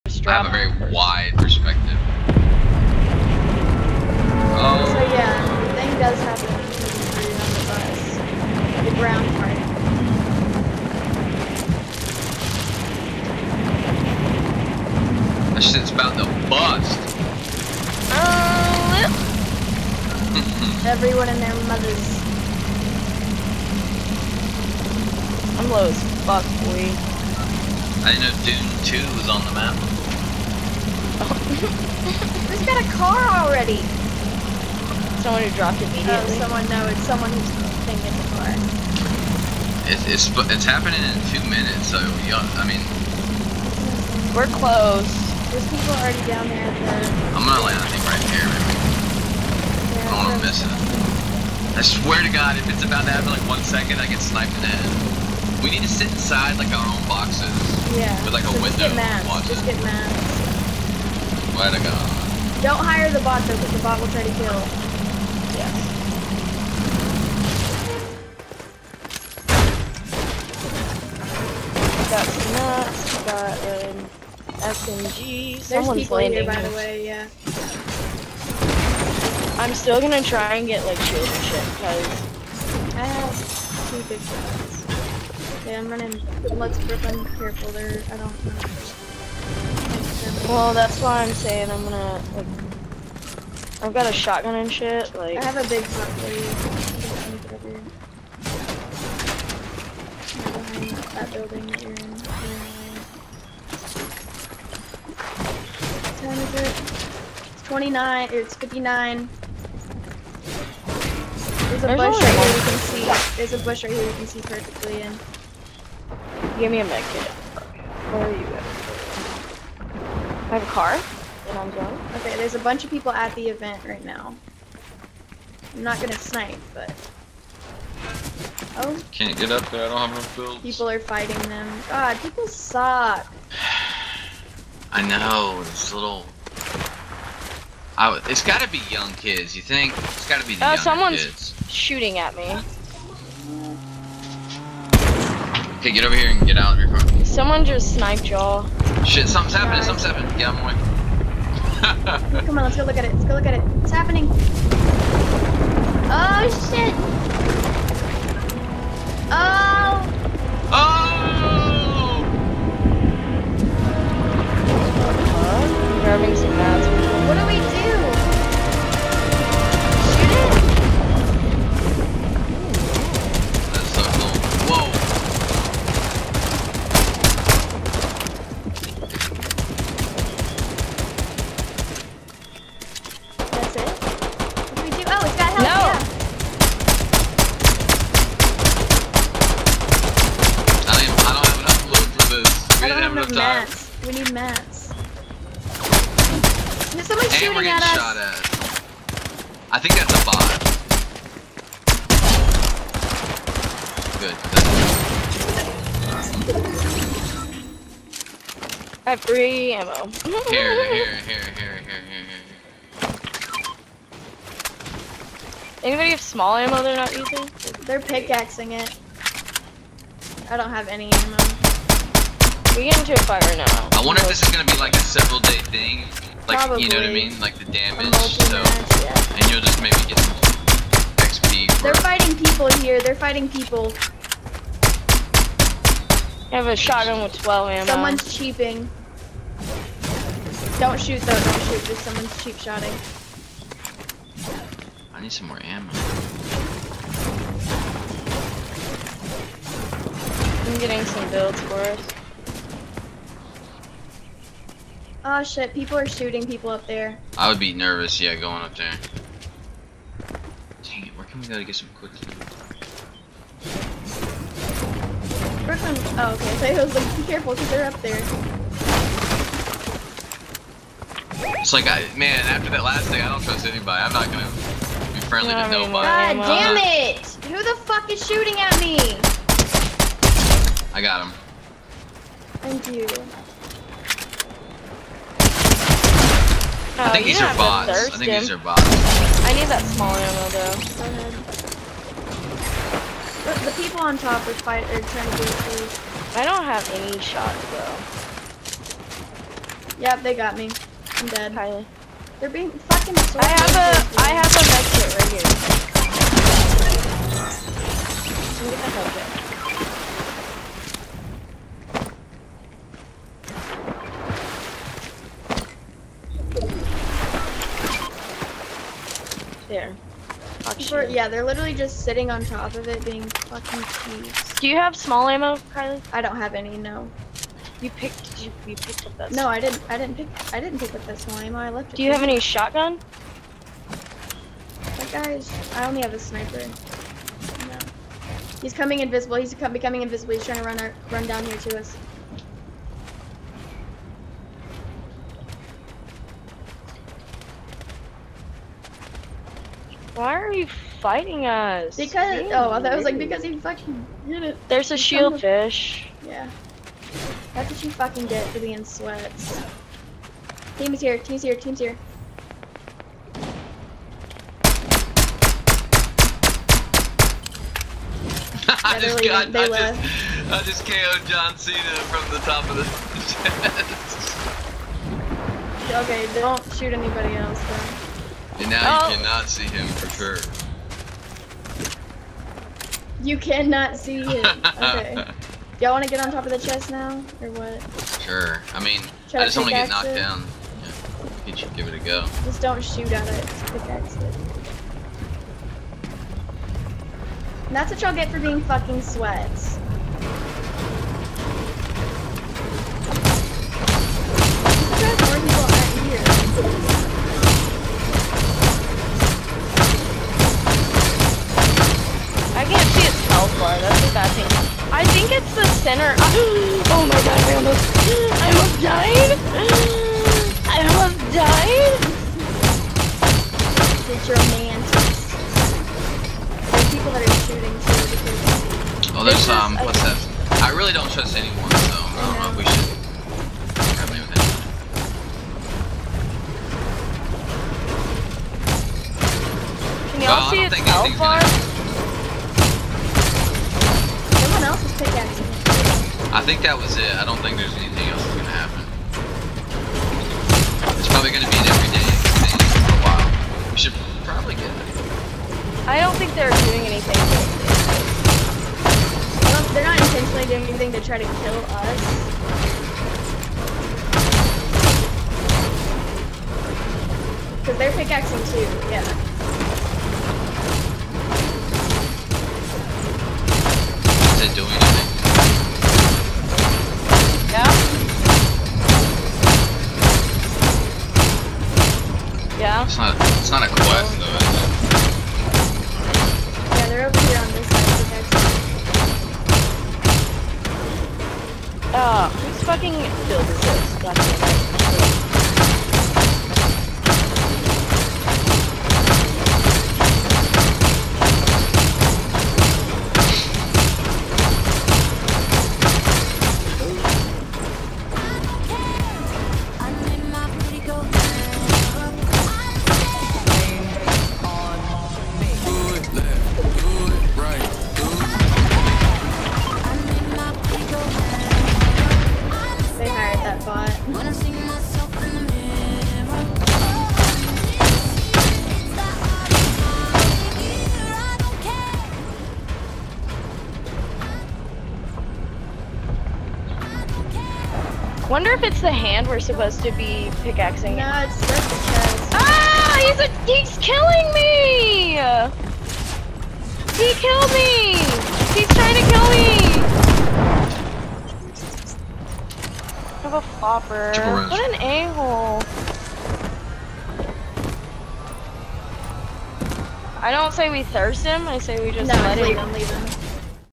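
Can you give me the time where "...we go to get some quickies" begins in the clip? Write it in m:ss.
4:21.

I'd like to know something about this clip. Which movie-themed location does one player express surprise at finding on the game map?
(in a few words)
Dune 2.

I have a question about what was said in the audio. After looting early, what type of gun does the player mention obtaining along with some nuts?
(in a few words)
SMG.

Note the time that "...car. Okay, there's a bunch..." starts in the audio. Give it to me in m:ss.
2:00.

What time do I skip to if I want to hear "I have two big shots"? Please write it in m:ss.
1:22.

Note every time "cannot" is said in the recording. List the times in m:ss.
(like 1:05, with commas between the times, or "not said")
6:19, 6:23.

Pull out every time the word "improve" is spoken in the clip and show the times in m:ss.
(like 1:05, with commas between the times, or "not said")
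not said.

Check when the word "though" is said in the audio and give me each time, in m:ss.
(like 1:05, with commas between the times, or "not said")
1:03, 4:01, 4:50, 4:59, 6:17.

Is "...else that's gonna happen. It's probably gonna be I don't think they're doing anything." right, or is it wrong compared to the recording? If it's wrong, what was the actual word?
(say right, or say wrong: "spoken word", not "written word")
right.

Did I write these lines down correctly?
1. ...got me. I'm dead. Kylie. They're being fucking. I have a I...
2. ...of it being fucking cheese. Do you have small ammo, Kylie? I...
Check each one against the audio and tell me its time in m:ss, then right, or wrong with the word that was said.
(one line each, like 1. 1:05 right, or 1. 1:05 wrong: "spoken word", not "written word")
1. 5:00 right
2. 5:22 right.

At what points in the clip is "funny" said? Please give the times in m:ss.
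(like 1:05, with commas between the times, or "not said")
not said.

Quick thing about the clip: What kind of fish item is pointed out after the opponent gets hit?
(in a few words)
shield fish.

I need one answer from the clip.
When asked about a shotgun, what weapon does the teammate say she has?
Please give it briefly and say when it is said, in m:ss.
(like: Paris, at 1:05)
sniper, at 5:36.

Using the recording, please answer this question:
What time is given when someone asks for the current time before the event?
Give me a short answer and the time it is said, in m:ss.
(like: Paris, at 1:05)
29, 59, at 1:47.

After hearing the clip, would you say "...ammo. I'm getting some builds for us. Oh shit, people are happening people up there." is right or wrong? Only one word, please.
wrong.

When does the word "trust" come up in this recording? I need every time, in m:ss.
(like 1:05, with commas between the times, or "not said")
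4:33, 7:11.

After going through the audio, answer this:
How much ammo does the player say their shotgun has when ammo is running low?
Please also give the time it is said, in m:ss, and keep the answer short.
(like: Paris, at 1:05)
12, at 3:57.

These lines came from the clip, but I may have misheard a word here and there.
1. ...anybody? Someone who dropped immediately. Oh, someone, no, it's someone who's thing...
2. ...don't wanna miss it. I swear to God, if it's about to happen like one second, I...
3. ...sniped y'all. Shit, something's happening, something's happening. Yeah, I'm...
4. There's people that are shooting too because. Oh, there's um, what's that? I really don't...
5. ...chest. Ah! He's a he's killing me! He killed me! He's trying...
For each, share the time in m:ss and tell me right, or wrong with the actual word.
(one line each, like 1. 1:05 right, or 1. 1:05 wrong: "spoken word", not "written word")
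1. 0:33 wrong: "already", not "anybody"
2. 0:50 right
3. 2:27 right
4. 7:06 right
5. 9:01 right.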